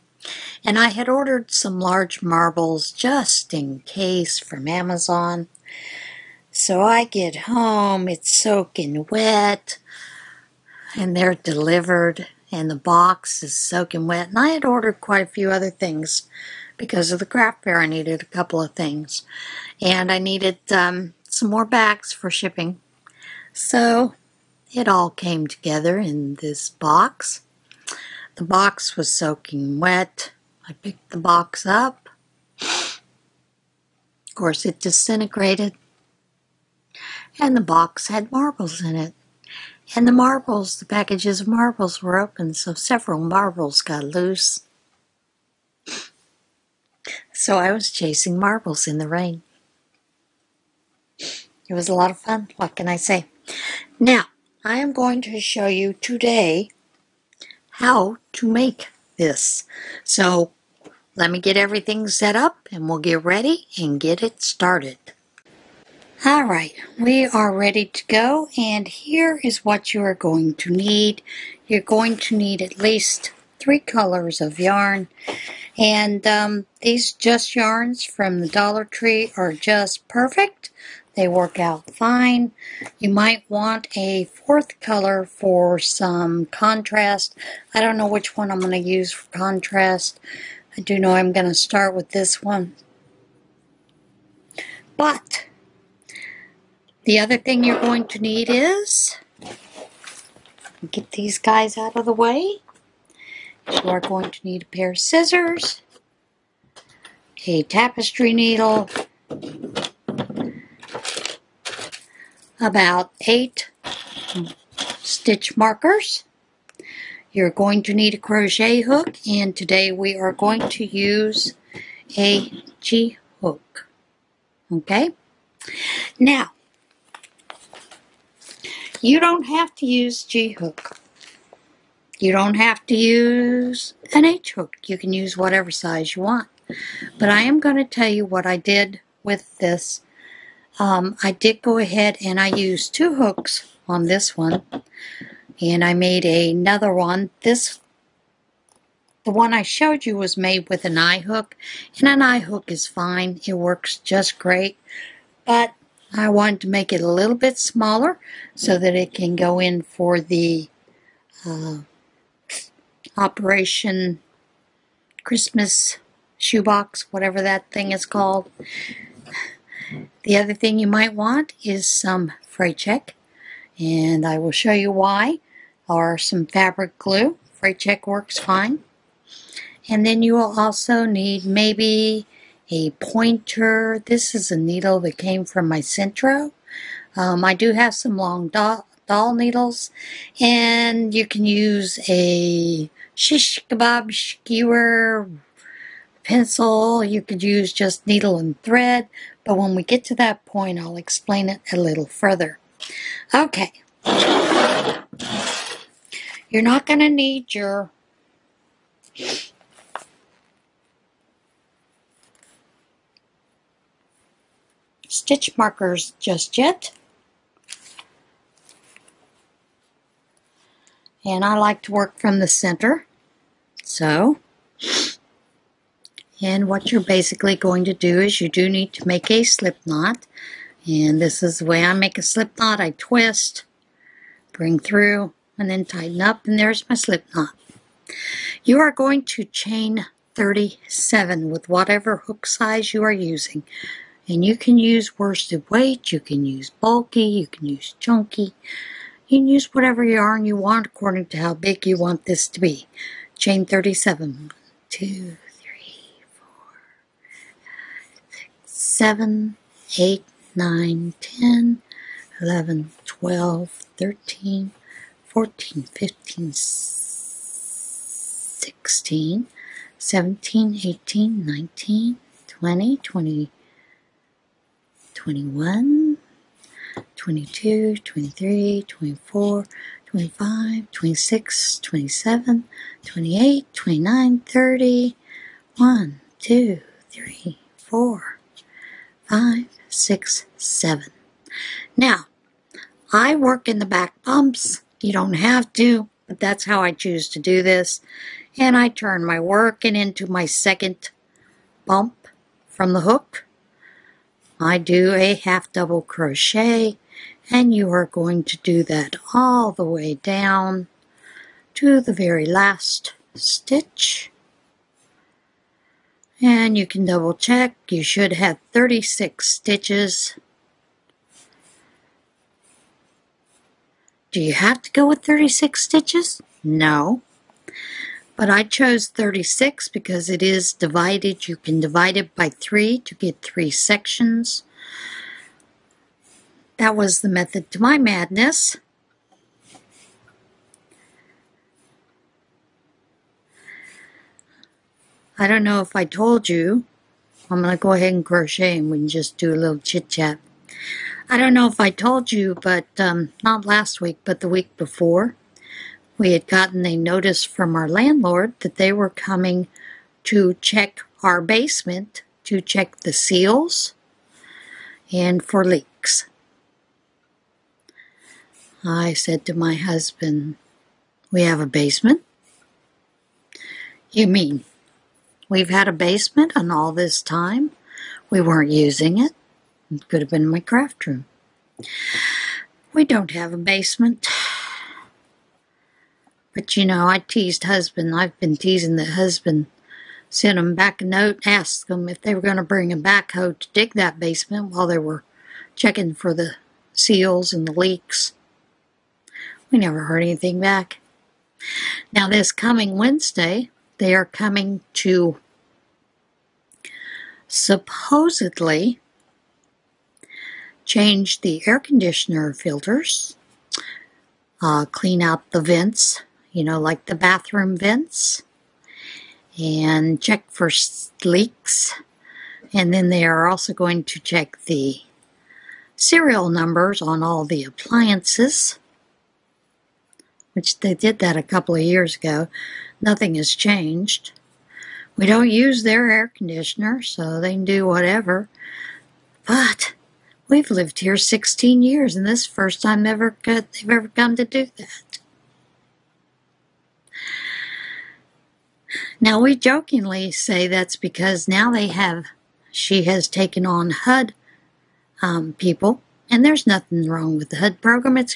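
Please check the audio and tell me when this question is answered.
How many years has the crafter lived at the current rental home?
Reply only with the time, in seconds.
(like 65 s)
441 s.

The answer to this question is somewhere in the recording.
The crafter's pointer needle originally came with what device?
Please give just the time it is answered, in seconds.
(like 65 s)
185 s.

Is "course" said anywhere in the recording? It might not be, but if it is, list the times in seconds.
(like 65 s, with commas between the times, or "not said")
34 s.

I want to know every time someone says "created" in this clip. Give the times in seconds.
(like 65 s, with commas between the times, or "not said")
not said.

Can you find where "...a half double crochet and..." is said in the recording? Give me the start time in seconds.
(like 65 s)
305 s.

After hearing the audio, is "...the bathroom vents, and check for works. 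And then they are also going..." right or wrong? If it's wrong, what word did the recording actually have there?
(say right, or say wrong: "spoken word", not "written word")
wrong: "leaks", not "works".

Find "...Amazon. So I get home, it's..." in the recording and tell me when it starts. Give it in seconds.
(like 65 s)
4 s.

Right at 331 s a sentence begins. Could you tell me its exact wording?
You can divide it by 3 to get 3 sections.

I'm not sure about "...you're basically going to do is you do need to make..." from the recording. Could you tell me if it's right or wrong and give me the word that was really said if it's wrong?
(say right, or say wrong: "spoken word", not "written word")
right.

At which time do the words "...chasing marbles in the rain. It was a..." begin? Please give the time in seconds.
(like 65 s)
47 s.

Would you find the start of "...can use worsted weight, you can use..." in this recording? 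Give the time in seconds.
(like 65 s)
244 s.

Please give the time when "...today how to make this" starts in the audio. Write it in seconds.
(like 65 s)
55 s.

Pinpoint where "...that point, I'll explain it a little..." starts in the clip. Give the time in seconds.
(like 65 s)
200 s.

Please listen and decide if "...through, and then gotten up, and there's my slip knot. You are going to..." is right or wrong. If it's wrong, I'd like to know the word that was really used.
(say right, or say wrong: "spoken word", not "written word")
wrong: "tighten", not "gotten".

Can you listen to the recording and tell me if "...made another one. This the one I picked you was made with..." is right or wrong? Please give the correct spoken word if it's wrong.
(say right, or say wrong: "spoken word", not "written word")
wrong: "showed", not "picked".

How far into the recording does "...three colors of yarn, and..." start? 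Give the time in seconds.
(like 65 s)
73 s.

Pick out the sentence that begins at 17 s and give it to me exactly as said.
I needed a couple of things, and I needed um, some more bags for shipping.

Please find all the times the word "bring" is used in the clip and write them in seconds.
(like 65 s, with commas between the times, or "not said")
234 s, 392 s.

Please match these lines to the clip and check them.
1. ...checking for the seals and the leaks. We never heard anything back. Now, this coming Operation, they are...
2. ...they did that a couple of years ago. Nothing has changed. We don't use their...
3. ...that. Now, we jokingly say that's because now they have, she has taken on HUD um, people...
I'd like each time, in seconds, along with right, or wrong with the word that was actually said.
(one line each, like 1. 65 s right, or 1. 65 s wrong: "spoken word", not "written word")
1. 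395 s wrong: "Wednesday", not "Operation"
2. 430 s right
3. 444 s right.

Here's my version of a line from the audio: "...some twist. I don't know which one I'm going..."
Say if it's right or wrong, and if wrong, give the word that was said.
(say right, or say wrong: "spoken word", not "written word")
wrong: "contrast", not "twist".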